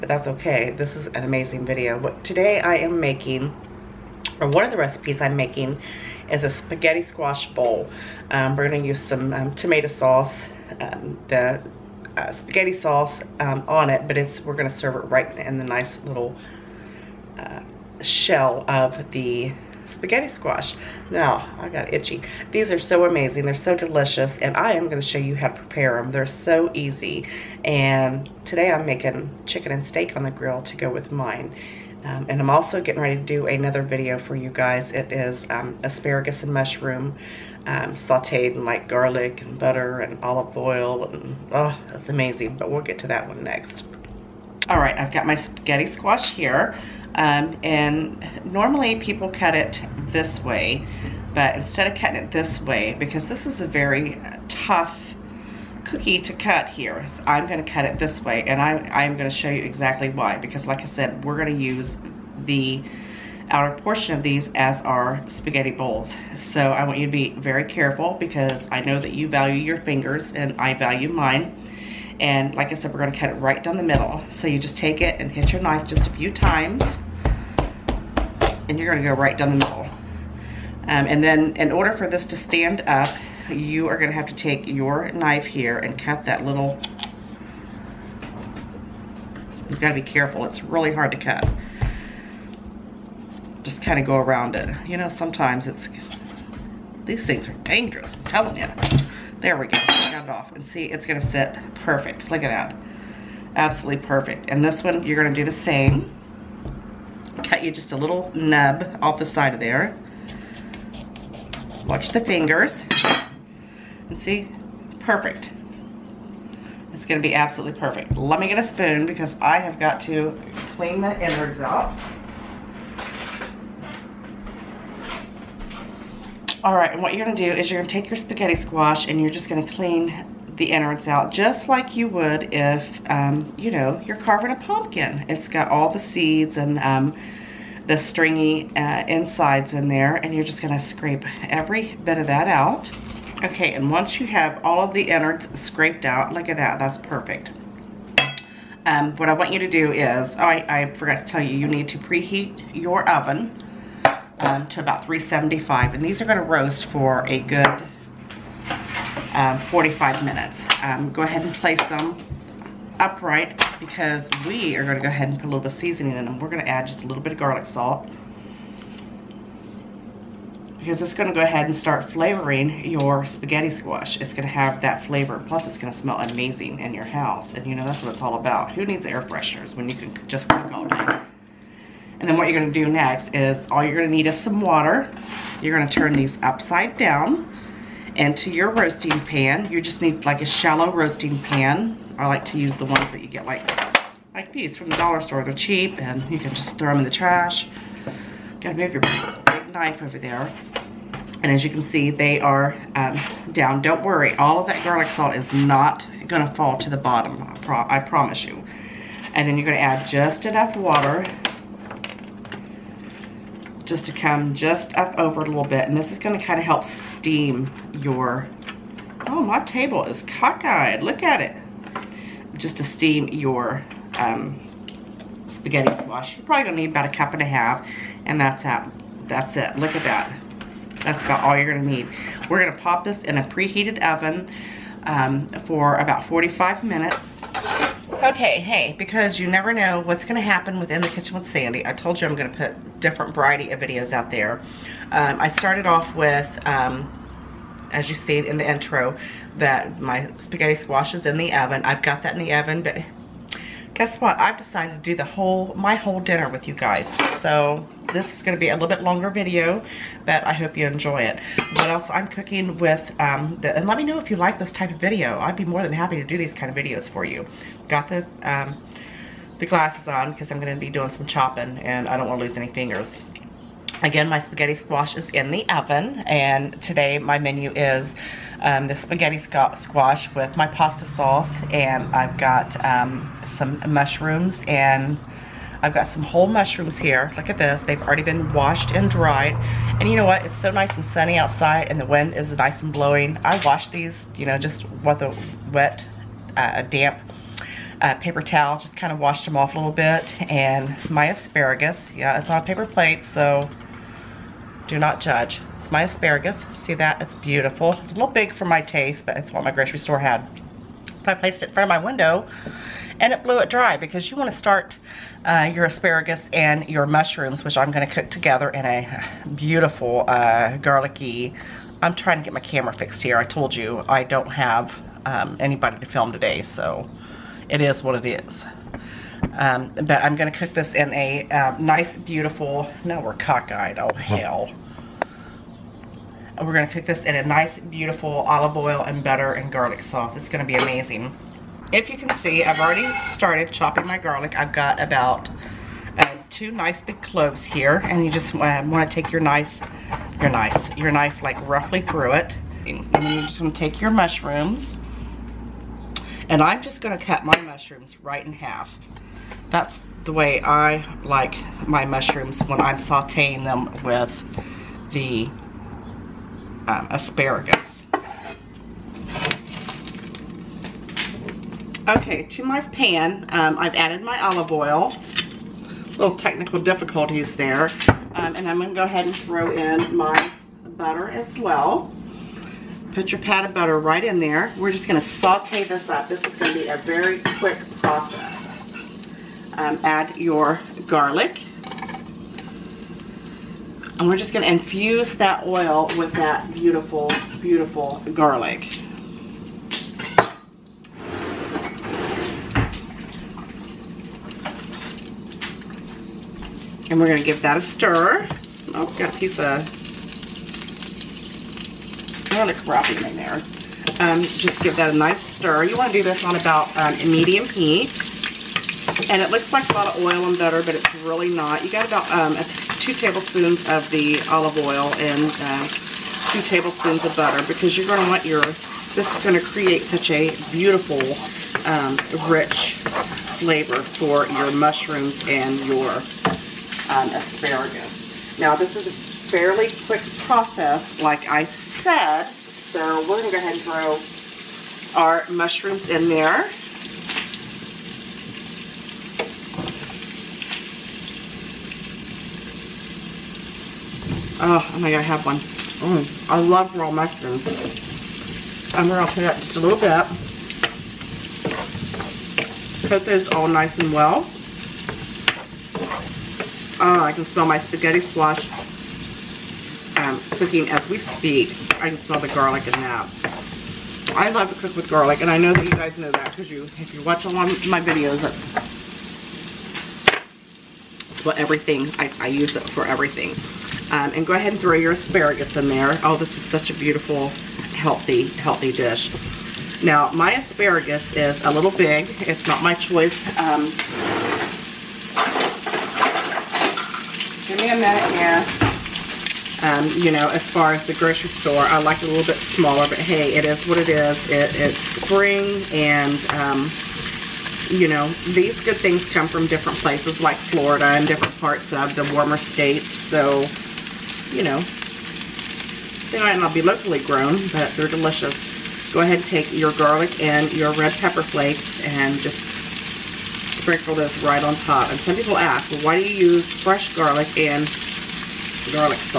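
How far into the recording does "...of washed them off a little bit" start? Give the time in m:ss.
4:59.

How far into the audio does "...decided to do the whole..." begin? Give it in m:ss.
4:14.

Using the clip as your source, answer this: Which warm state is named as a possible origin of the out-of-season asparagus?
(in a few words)
Florida.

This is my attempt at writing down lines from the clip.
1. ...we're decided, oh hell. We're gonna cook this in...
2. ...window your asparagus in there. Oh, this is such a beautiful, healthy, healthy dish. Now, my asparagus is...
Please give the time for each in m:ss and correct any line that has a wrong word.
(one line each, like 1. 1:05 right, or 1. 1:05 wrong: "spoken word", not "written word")
1. 5:33 wrong: "cockeyed", not "decided"
2. 8:04 wrong: "throw", not "window".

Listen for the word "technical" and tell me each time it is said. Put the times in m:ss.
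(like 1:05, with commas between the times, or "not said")
6:16.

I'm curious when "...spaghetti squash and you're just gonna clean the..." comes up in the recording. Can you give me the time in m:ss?
2:08.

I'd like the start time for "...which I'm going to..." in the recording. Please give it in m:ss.
5:17.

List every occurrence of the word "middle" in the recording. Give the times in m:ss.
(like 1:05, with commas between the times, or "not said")
1:13, 1:19.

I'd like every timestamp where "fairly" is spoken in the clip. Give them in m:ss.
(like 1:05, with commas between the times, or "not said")
7:19.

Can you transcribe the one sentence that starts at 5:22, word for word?
I'm trying to get my camera fixed here.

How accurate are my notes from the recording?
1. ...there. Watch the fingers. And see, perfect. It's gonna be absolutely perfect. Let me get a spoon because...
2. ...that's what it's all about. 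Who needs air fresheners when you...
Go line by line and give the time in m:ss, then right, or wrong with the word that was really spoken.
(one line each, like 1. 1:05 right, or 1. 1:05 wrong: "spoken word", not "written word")
1. 1:49 right
2. 2:57 right.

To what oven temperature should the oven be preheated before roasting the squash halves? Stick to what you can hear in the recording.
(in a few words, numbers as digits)
375.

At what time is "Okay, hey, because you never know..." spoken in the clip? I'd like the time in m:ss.
3:58.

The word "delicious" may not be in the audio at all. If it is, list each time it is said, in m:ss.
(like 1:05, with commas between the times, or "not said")
0:23, 8:38.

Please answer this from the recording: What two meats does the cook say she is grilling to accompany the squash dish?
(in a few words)
chicken and steak.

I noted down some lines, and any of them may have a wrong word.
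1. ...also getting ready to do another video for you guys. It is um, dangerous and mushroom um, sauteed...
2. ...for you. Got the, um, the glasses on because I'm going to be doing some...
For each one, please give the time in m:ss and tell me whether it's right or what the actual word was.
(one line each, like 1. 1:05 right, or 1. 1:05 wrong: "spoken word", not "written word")
1. 0:32 wrong: "asparagus", not "dangerous"
2. 4:27 right.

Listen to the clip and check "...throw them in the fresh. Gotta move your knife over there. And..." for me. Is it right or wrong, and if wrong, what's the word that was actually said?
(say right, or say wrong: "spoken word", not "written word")
wrong: "trash", not "fresh".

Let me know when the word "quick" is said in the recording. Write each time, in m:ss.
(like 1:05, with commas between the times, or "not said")
6:27, 7:20.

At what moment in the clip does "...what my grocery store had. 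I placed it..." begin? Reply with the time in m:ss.
5:09.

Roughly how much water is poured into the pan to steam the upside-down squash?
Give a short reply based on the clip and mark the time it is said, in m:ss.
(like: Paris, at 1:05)
a cup and a half, at 3:47.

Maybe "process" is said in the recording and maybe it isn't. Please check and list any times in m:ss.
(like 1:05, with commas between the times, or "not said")
6:28, 7:20.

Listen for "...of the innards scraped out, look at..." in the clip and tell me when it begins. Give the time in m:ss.
2:24.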